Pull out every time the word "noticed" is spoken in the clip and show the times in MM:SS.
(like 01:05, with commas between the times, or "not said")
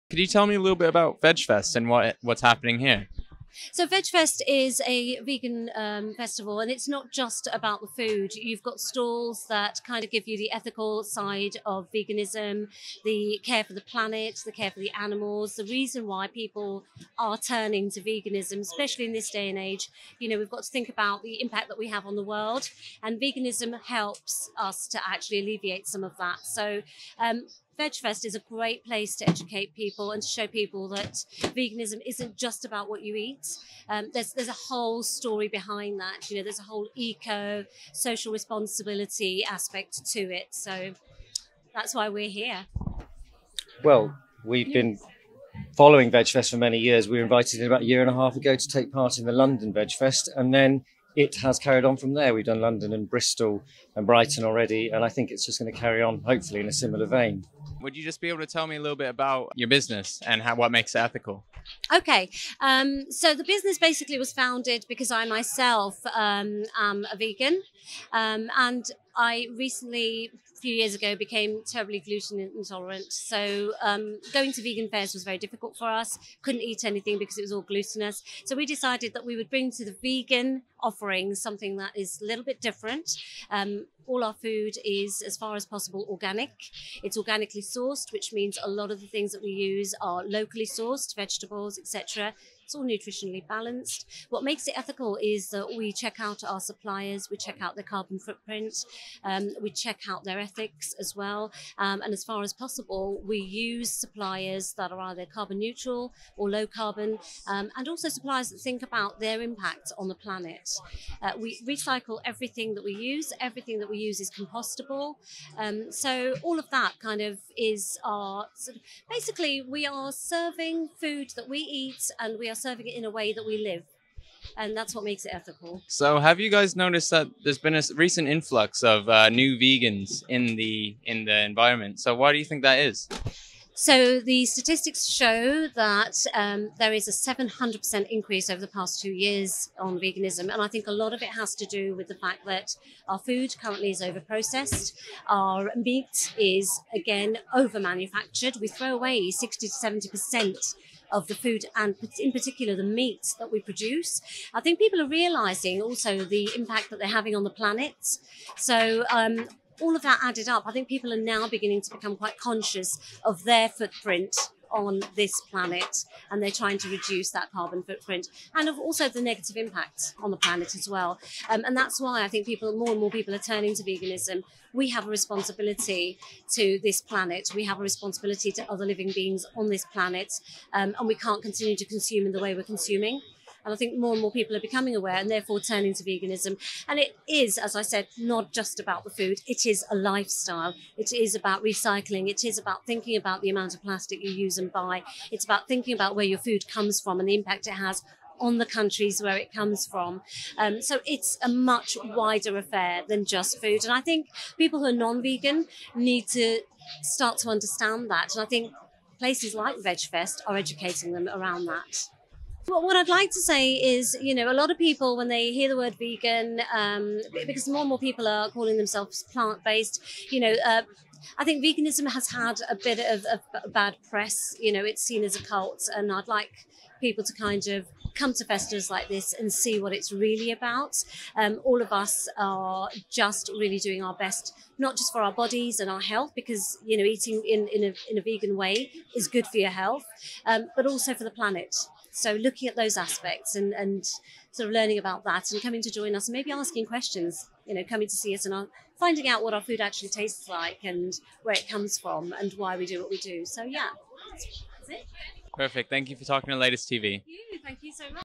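02:06.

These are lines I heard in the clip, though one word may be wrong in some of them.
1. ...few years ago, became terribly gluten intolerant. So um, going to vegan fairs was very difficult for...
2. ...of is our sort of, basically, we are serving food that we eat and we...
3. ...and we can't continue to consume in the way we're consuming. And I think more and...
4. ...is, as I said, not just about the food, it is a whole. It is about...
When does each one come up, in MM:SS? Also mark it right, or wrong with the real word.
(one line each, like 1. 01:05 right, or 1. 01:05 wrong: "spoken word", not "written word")
1. 01:10 right
2. 01:57 right
3. 03:00 right
4. 03:07 wrong: "lifestyle", not "whole".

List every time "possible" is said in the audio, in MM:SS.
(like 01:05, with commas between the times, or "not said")
01:25, 01:42.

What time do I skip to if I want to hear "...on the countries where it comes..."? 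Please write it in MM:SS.
03:18.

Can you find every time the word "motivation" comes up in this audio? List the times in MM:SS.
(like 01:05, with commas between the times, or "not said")
not said.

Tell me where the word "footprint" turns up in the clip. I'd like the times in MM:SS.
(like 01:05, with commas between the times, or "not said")
01:38, 02:43, 02:47.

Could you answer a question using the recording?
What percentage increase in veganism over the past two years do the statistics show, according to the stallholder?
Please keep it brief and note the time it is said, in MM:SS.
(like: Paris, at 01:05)
700%, at 02:17.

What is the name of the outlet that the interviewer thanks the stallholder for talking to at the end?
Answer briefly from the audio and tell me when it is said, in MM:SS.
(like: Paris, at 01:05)
Latest TV, at 04:16.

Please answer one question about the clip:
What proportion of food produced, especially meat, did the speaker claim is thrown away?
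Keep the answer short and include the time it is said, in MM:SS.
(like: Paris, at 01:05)
60 to 70%, at 02:29.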